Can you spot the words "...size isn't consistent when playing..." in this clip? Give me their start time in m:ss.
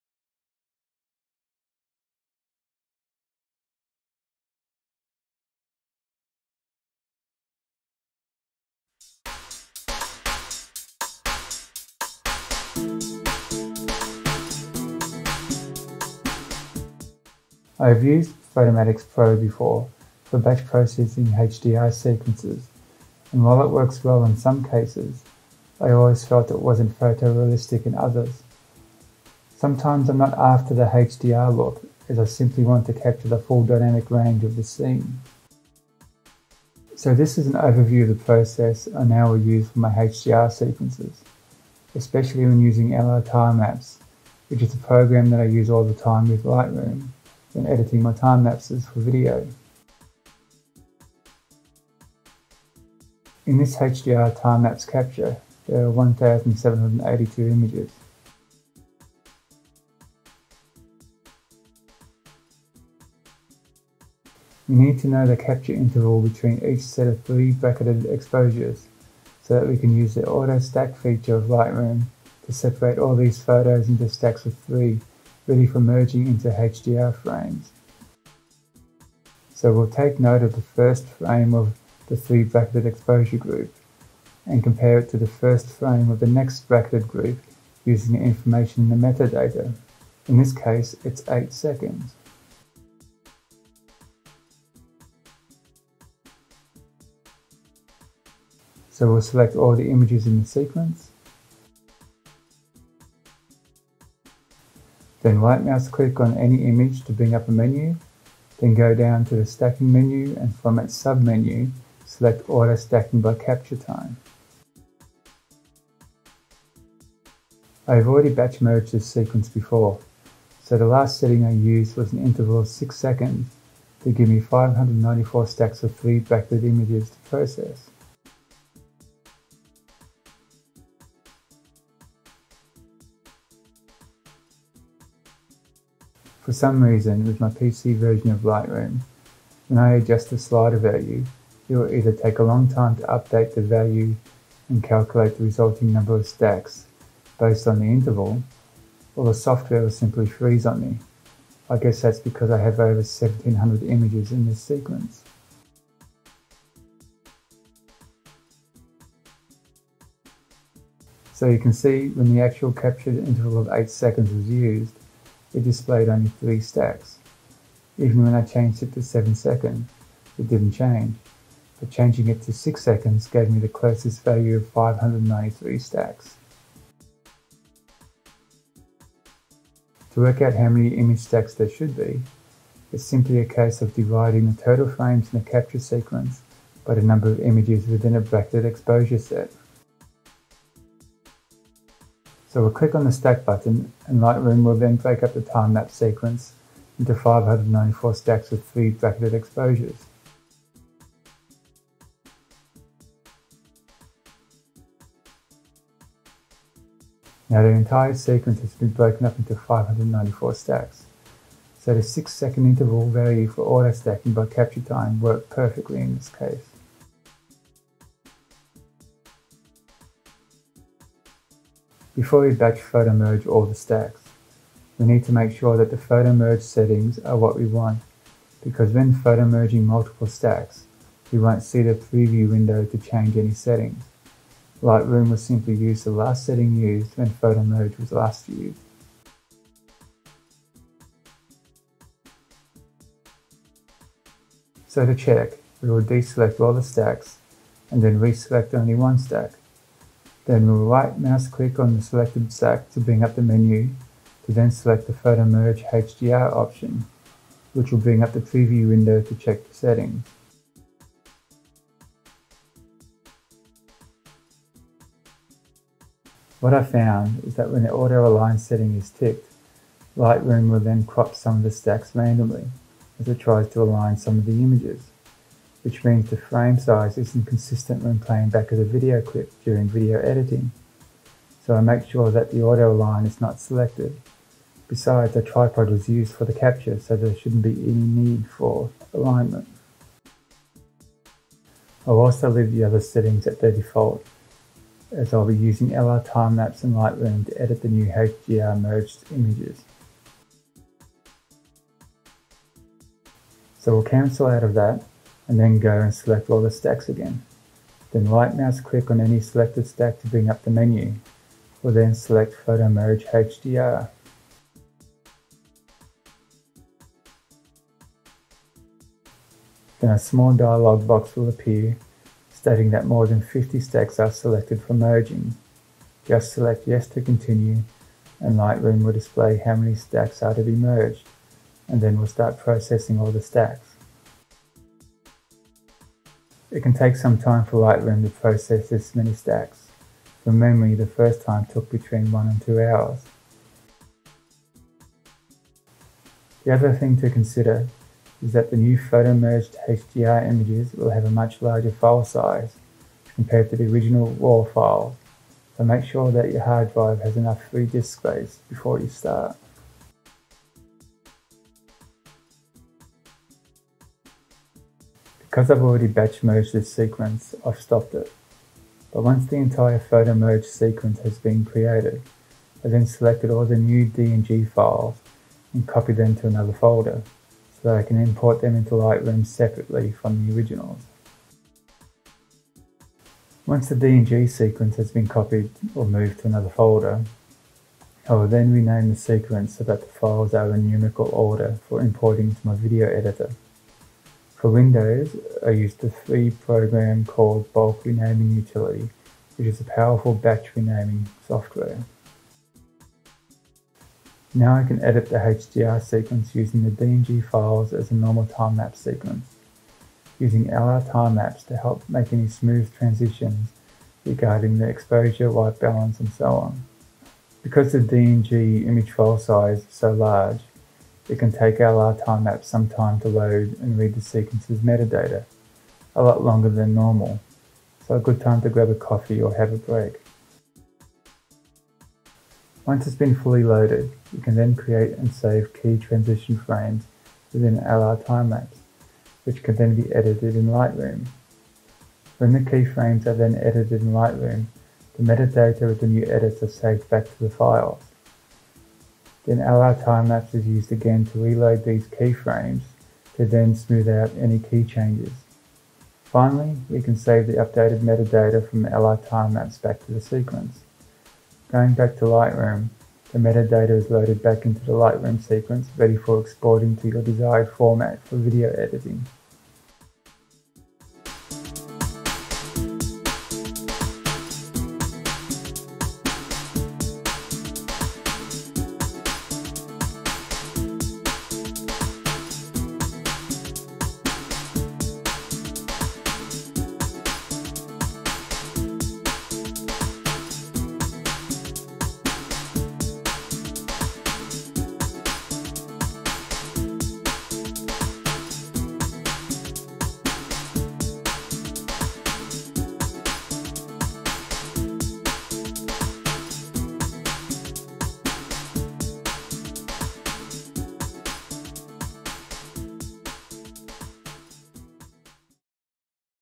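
4:36.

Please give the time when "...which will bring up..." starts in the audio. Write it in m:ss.
4:17.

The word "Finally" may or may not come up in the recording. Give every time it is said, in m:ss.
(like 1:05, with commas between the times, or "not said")
7:36.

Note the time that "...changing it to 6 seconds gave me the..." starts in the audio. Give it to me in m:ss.
2:51.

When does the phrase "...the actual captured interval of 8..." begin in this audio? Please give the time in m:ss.
2:42.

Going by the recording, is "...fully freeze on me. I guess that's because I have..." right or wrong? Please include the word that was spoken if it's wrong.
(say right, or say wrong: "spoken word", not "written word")
wrong: "simply", not "fully".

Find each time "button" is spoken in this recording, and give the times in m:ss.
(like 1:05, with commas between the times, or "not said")
3:13.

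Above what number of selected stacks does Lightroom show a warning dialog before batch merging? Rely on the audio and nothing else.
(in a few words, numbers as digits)
50.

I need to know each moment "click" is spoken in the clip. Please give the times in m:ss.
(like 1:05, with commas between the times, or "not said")
1:45, 3:12, 4:11, 5:08.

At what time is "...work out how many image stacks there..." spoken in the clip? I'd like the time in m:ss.
3:00.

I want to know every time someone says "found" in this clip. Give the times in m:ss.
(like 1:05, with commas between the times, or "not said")
4:26.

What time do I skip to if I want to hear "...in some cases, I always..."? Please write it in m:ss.
0:24.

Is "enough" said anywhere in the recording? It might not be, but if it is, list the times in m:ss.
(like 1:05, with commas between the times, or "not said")
5:57.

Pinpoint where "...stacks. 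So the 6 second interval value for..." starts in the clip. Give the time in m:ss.
3:30.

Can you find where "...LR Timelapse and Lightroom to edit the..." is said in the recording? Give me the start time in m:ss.
4:55.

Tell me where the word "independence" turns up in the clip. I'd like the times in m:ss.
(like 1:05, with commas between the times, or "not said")
not said.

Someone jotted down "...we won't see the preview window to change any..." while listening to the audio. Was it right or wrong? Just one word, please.
right.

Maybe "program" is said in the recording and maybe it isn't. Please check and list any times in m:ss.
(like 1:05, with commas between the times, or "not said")
0:44, 6:36.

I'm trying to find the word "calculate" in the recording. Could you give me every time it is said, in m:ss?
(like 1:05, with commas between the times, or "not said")
2:24.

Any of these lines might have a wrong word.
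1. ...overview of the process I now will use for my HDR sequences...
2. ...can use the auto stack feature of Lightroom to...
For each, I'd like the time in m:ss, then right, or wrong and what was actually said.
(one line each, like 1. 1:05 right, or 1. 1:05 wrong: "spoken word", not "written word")
1. 0:37 right
2. 1:09 right.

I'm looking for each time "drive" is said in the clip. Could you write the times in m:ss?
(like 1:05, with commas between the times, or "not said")
5:56.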